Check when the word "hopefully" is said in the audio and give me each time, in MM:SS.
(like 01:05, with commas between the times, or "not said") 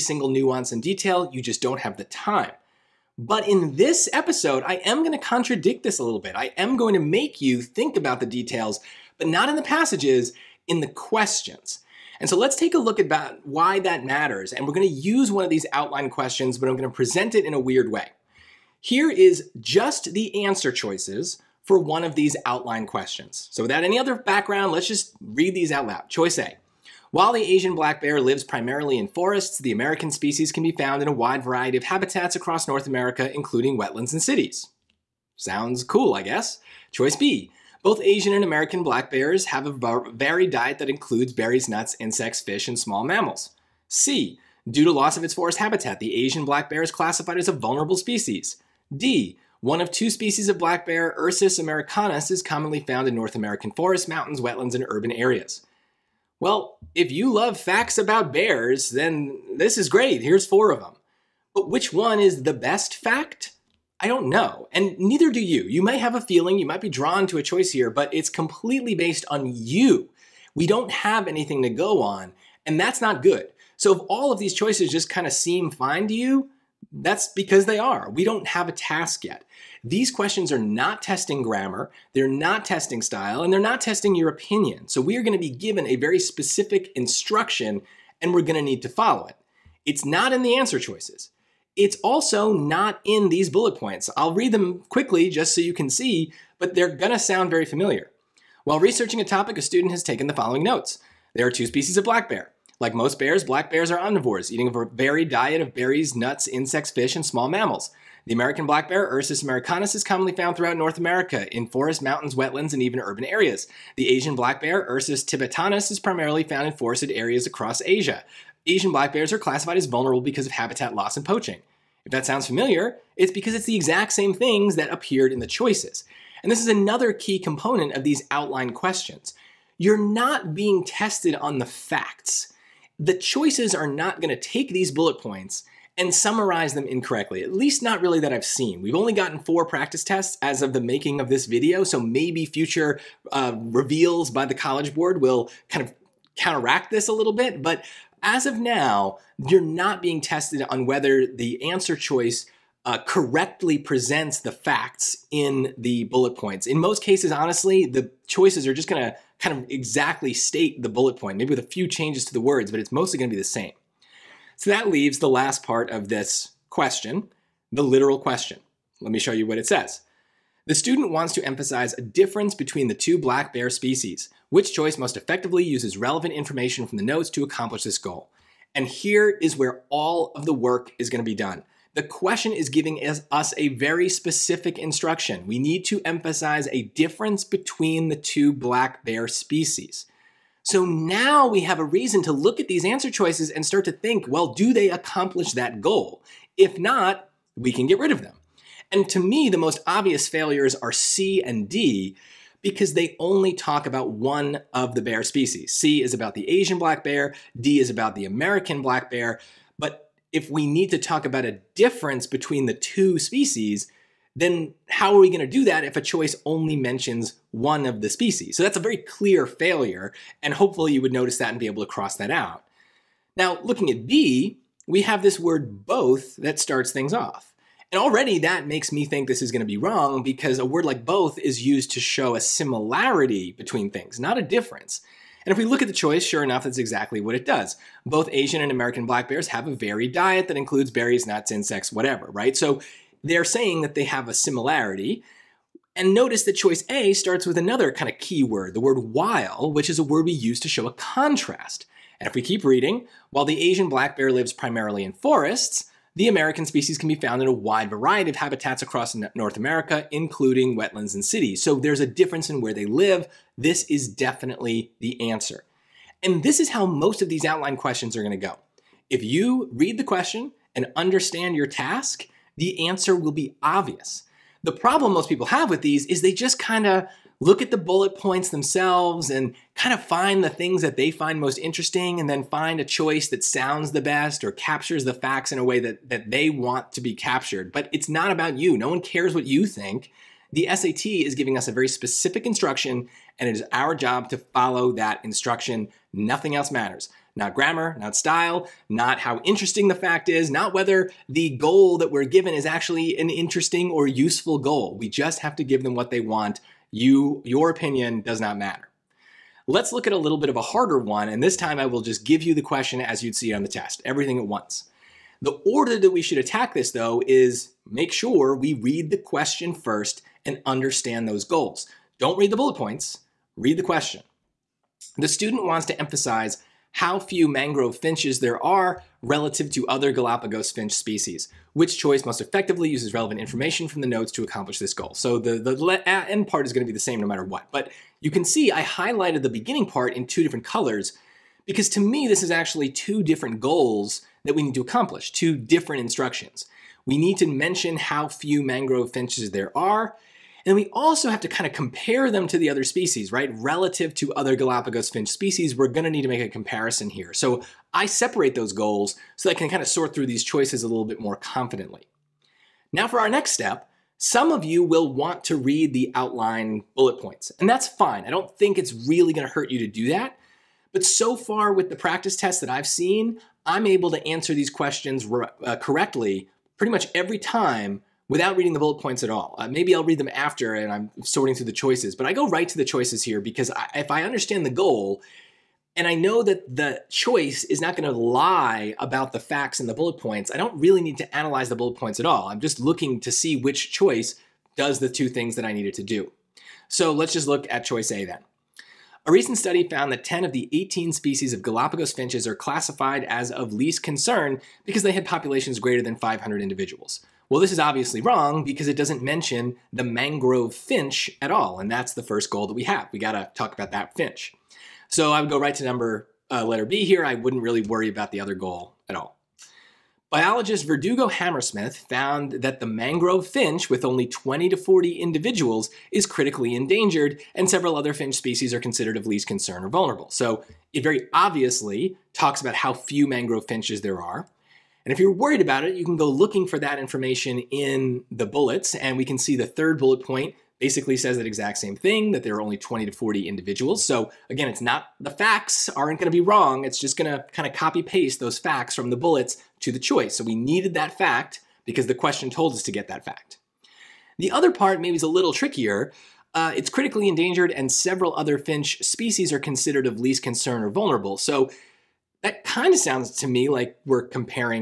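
03:40.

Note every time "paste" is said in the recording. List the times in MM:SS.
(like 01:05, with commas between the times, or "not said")
07:28.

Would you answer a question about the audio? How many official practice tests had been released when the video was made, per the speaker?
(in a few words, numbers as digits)
4.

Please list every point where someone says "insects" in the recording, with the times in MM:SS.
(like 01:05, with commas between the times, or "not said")
00:41, 01:46, 04:01.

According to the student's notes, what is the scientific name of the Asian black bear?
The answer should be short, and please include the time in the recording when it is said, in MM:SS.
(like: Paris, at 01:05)
Ursus tibetanus, at 01:54.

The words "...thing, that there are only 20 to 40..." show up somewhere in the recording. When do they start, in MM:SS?
07:21.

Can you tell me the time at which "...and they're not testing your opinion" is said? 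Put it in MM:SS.
01:23.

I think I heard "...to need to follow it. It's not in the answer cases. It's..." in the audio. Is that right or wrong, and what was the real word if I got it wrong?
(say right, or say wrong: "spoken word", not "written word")
wrong: "choices", not "cases".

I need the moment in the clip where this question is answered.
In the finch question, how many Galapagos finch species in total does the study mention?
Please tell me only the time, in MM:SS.
06:40.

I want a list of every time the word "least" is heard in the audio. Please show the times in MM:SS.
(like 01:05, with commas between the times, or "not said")
02:17, 06:43, 07:09, 07:40.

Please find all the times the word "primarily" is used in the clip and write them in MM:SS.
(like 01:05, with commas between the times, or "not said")
00:28, 01:55, 04:14.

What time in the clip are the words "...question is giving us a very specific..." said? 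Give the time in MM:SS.
03:02.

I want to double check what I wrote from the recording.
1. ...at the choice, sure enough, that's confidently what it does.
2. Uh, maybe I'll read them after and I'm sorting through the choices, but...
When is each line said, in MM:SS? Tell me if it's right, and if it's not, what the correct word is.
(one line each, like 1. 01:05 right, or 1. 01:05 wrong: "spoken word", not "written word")
1. 03:55 wrong: "exactly", not "confidently"
2. 06:19 right.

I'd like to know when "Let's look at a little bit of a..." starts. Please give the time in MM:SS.
05:09.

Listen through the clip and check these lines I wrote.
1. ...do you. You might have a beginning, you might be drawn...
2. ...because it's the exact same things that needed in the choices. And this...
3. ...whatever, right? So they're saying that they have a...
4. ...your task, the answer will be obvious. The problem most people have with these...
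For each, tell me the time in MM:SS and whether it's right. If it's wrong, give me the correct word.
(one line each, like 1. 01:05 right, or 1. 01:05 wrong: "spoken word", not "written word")
1. 01:05 wrong: "feeling", not "beginning"
2. 02:03 wrong: "appeared", not "needed"
3. 04:01 right
4. 04:31 right.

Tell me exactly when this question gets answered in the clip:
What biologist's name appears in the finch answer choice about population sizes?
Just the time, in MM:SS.
07:00.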